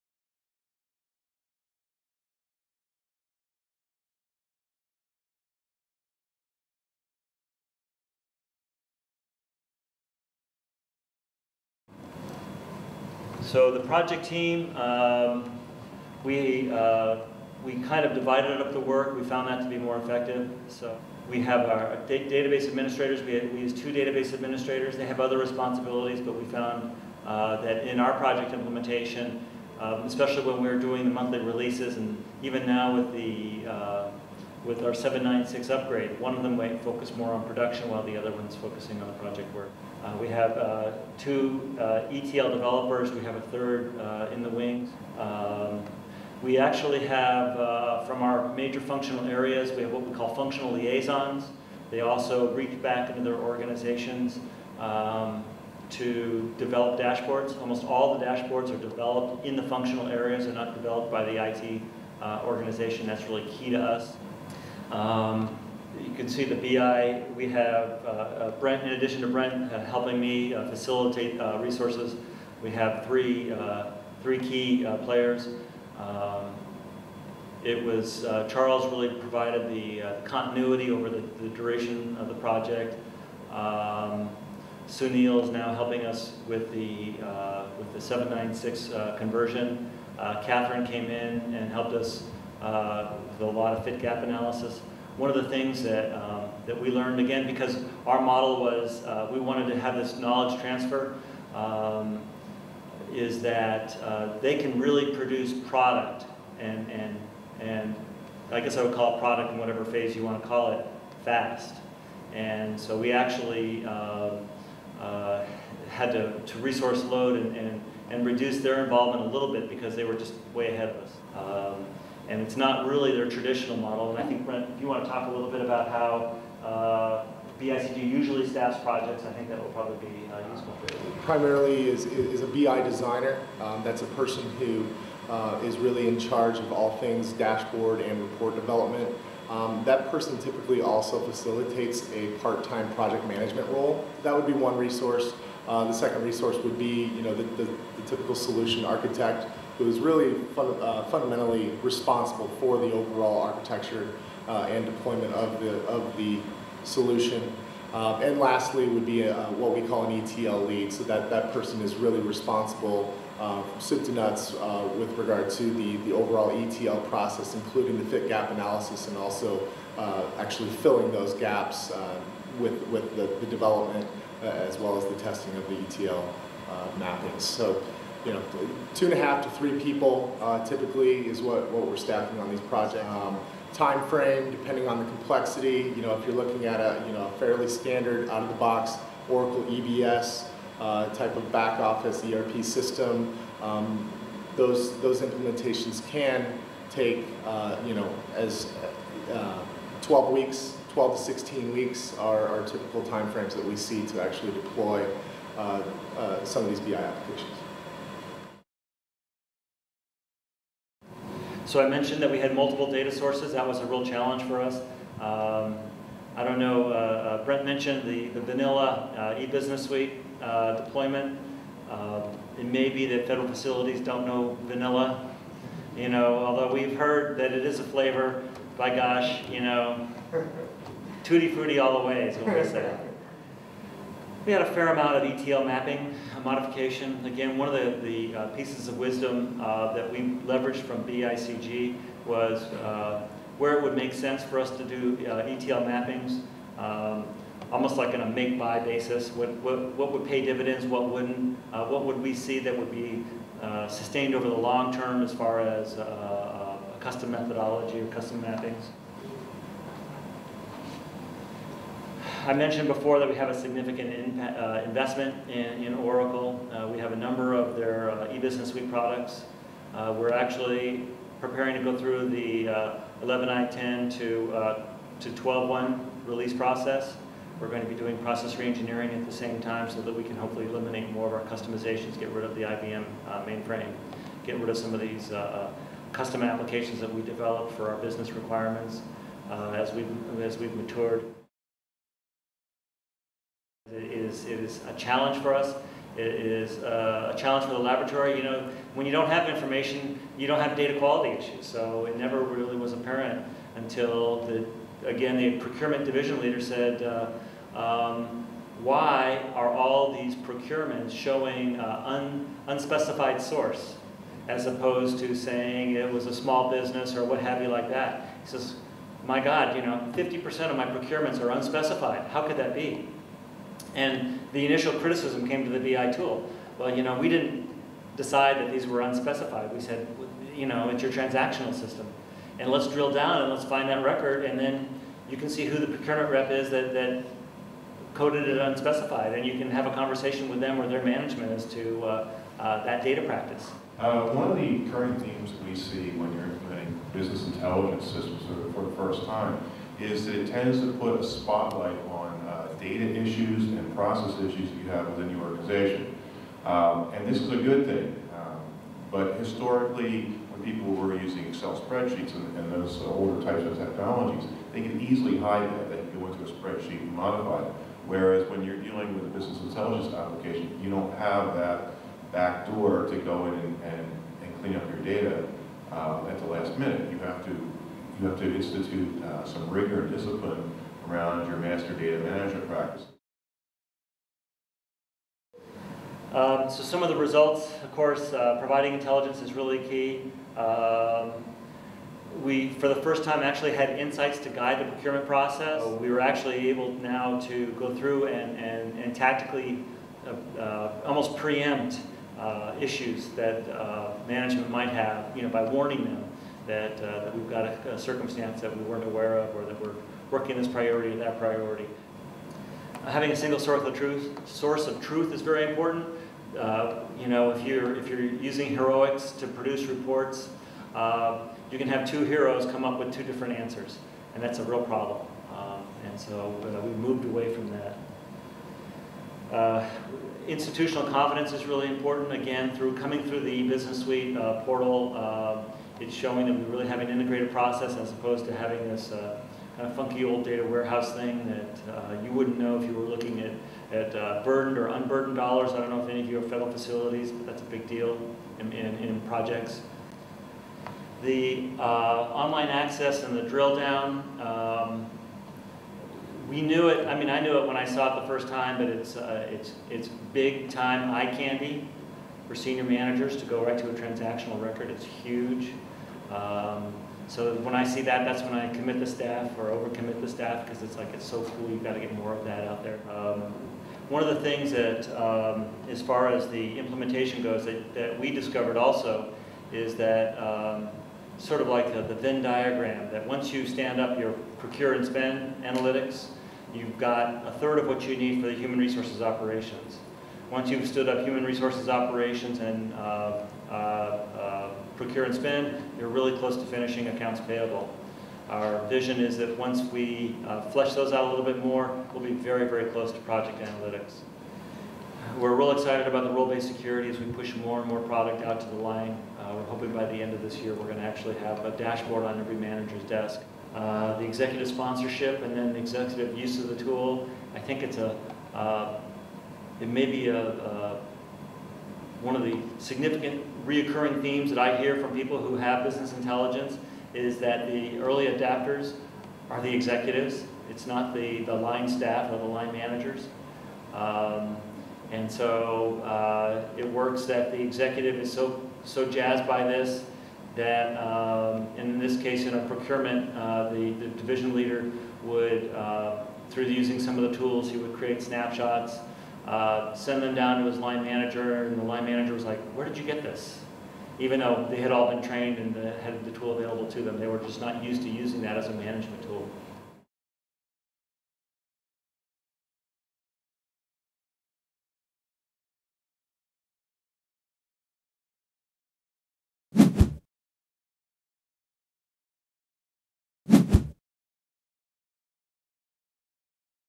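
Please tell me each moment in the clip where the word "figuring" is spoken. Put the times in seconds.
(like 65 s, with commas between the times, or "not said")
not said.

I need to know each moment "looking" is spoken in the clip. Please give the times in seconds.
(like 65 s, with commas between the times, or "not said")
186 s, 443 s.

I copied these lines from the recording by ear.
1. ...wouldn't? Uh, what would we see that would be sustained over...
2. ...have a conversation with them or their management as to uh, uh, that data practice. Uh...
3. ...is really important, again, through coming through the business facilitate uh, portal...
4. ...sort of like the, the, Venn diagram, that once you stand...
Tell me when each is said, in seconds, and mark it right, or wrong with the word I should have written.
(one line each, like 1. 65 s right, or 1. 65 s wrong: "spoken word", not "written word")
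1. 251 s right
2. 339 s right
3. 431 s wrong: "suite", not "facilitate"
4. 481 s right.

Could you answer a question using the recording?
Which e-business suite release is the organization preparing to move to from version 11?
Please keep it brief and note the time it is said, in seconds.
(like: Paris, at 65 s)
12.1, at 275 s.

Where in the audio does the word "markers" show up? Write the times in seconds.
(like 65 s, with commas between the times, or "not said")
not said.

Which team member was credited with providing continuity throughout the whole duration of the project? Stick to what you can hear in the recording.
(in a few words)
Charles.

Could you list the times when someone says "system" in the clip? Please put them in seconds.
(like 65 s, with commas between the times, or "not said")
192 s, 331 s, 348 s.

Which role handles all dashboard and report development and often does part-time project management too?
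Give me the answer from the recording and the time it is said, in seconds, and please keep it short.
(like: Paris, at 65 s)
BI designer, at 132 s.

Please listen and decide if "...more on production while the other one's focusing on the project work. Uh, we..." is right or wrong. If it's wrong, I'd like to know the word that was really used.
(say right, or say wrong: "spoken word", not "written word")
right.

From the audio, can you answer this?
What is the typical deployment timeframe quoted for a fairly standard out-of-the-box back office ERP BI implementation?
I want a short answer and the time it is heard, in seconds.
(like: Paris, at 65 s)
12 to 16 weeks, at 200 s.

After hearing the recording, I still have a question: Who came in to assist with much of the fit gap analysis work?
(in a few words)
Catherine.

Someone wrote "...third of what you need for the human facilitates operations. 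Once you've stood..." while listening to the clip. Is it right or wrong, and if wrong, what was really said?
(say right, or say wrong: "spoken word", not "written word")
wrong: "resources", not "facilitates".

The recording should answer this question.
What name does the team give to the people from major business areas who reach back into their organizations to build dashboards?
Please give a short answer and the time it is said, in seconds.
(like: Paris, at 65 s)
functional liaisons, at 50 s.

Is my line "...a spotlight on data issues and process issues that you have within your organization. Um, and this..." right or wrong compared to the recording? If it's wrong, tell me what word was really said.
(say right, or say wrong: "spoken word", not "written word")
right.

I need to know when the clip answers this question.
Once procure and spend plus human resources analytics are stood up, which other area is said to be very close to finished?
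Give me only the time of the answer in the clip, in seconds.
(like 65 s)
497 s.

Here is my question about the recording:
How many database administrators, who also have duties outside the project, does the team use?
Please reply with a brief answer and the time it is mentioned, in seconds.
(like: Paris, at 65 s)
2, at 23 s.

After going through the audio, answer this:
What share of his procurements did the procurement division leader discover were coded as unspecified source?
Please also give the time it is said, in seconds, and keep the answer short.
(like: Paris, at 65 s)
50%, at 320 s.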